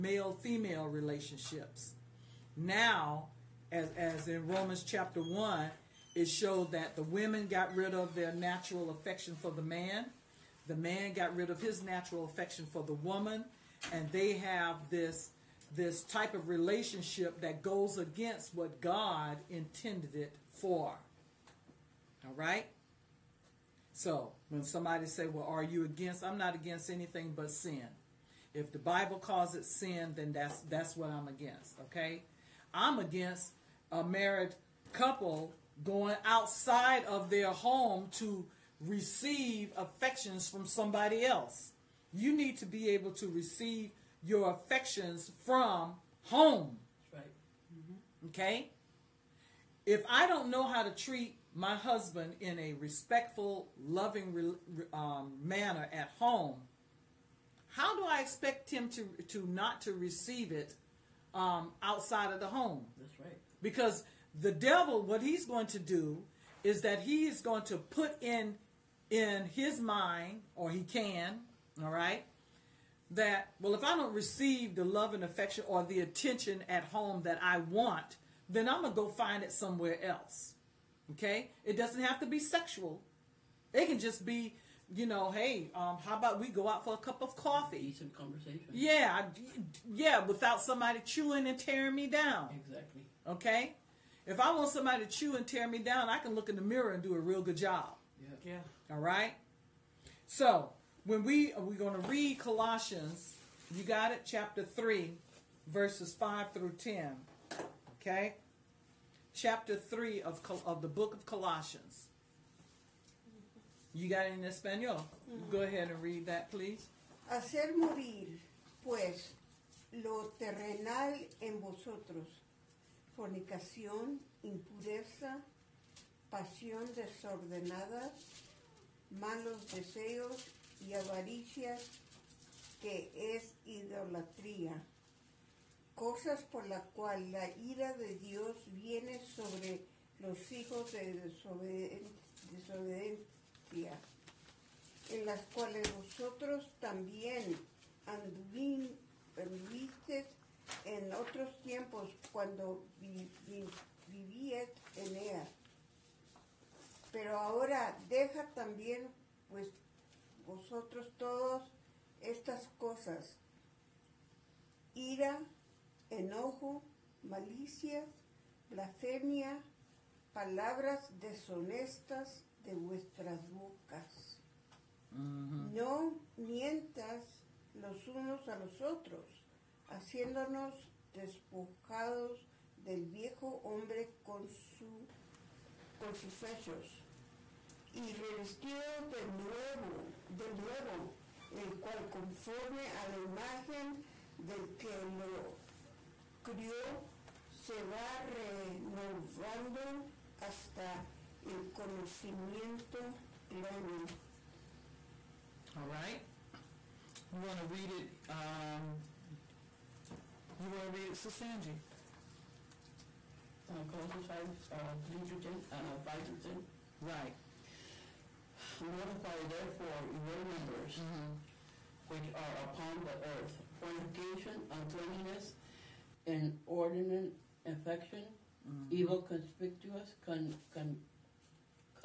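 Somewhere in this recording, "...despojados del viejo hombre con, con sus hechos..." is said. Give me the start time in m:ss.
3:01.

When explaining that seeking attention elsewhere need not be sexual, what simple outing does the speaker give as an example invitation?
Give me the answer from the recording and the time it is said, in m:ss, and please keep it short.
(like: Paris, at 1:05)
a cup of coffee, at 1:26.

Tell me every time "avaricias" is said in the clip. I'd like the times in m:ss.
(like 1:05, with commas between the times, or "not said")
2:10.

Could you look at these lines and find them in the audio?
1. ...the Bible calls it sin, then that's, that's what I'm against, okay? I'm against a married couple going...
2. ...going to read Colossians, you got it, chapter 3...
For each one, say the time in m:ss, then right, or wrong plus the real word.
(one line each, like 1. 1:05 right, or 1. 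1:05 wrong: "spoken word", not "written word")
1. 0:28 right
2. 1:41 right.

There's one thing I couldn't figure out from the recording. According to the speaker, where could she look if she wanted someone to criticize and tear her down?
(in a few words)
the mirror.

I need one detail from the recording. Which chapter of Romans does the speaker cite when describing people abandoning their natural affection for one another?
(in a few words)
Romans chapter 1.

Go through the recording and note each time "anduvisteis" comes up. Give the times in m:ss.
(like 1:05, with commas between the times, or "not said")
2:28.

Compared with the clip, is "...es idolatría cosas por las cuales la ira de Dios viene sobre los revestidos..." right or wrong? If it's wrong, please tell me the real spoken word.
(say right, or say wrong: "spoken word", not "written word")
wrong: "hijos", not "revestidos".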